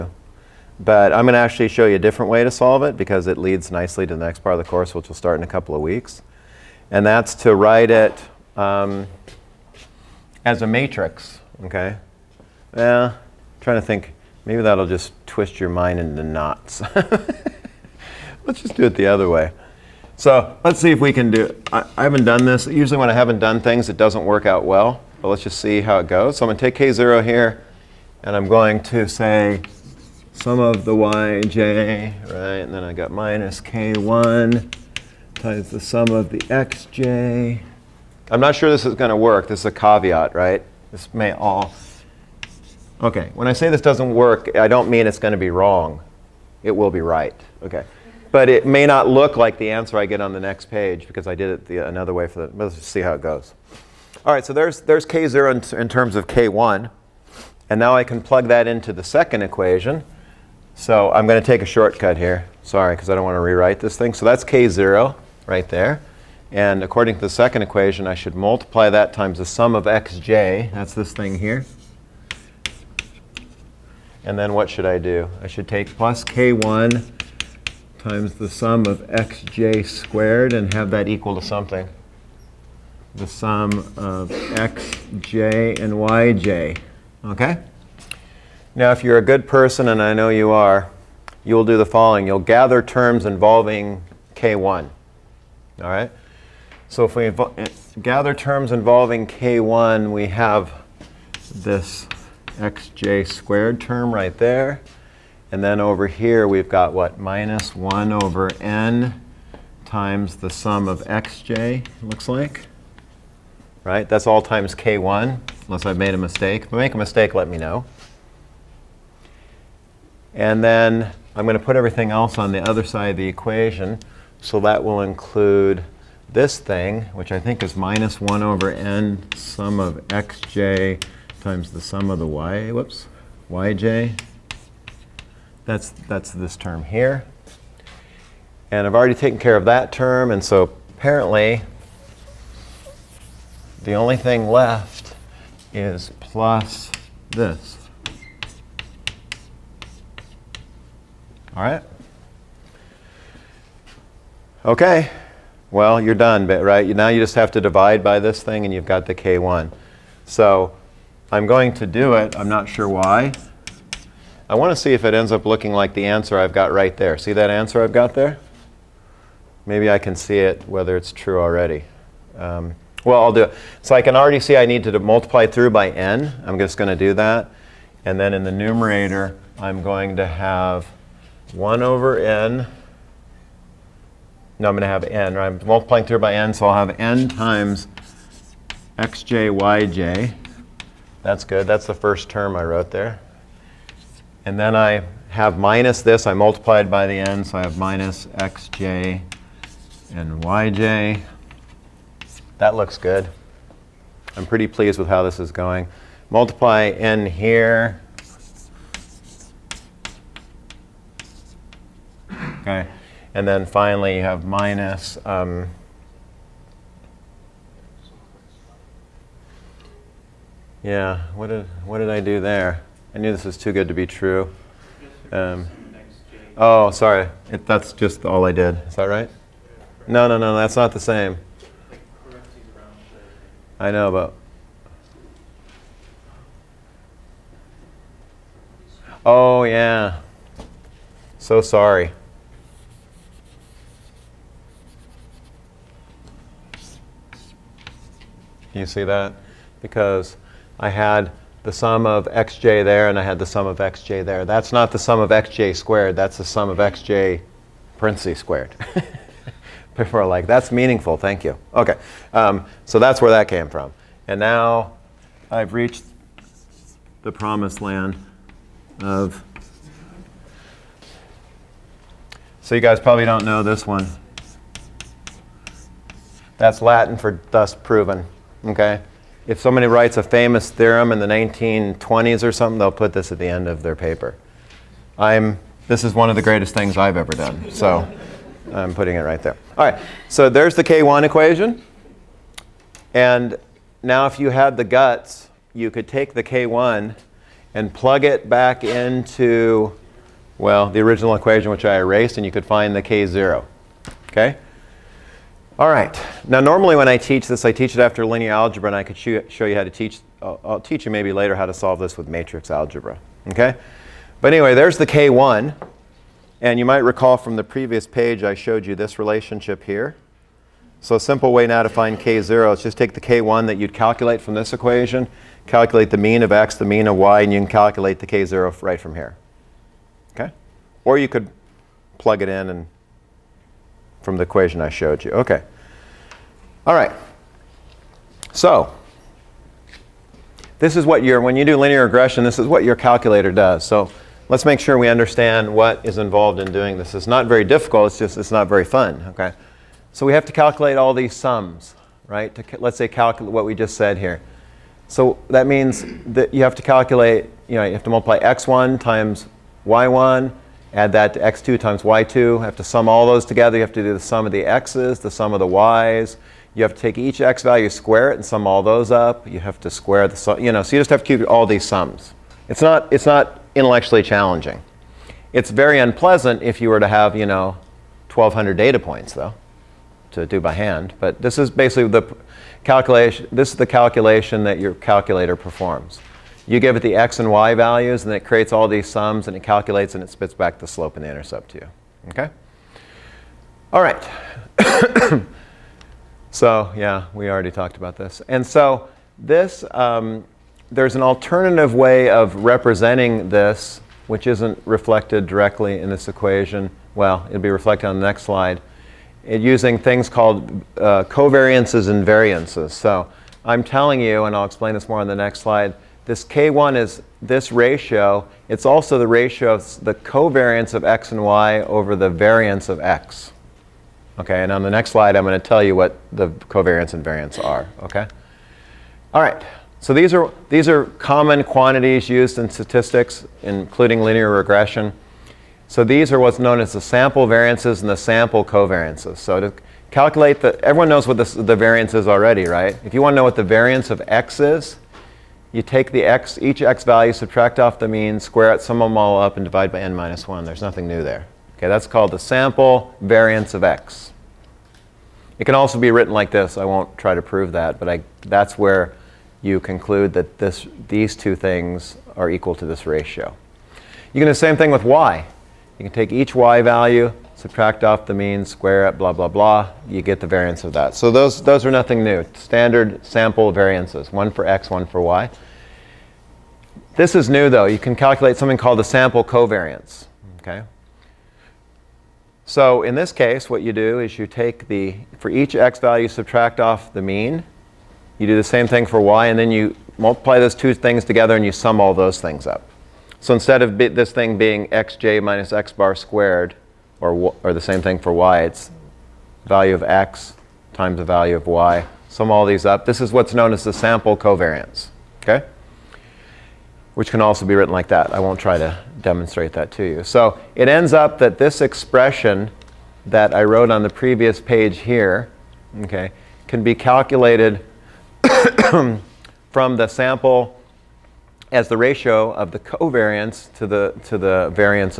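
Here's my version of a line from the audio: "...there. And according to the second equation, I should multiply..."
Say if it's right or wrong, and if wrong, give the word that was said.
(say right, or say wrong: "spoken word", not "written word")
right.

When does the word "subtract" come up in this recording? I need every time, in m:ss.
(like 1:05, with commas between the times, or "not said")
7:27, 7:47, 8:06.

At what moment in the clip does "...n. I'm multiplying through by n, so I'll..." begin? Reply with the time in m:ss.
3:05.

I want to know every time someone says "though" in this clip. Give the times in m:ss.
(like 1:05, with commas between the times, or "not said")
6:19, 7:57.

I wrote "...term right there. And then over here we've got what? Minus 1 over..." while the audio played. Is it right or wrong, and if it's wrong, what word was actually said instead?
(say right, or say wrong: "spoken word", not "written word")
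right.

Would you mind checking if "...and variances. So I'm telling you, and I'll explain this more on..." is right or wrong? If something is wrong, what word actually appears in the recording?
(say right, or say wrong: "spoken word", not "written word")
right.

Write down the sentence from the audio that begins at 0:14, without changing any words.
Maybe that'll just twist your mind into knots.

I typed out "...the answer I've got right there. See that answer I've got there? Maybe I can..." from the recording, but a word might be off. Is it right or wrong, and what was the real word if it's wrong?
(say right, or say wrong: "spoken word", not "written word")
right.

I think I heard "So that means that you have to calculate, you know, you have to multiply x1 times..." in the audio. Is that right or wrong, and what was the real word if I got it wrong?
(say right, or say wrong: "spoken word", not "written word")
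right.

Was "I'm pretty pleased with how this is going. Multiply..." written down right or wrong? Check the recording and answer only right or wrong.
right.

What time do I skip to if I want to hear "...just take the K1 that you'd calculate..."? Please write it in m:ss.
5:22.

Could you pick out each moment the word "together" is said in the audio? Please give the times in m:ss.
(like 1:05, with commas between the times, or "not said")
6:03, 8:11.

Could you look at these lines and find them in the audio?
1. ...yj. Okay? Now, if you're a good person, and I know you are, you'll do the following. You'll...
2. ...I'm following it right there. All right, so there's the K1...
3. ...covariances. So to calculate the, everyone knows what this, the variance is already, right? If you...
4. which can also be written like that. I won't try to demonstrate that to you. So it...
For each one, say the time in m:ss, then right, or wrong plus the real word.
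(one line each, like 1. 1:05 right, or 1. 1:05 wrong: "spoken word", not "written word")
1. 1:25 right
2. 4:48 wrong: "putting", not "following"
3. 7:18 right
4. 8:27 right.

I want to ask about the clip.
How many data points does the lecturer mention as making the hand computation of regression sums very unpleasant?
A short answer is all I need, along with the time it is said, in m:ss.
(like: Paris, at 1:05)
1,200, at 6:18.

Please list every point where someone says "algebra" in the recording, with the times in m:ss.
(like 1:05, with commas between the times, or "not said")
5:08, 5:12.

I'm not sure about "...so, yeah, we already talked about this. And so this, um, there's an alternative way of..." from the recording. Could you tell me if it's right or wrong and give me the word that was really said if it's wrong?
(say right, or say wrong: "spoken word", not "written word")
right.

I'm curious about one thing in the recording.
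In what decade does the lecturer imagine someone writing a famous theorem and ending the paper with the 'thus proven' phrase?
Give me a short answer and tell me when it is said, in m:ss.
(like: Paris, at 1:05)
1920s, at 4:41.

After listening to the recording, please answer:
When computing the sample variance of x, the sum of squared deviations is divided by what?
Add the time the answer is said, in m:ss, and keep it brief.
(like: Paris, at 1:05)
n minus 1, at 7:29.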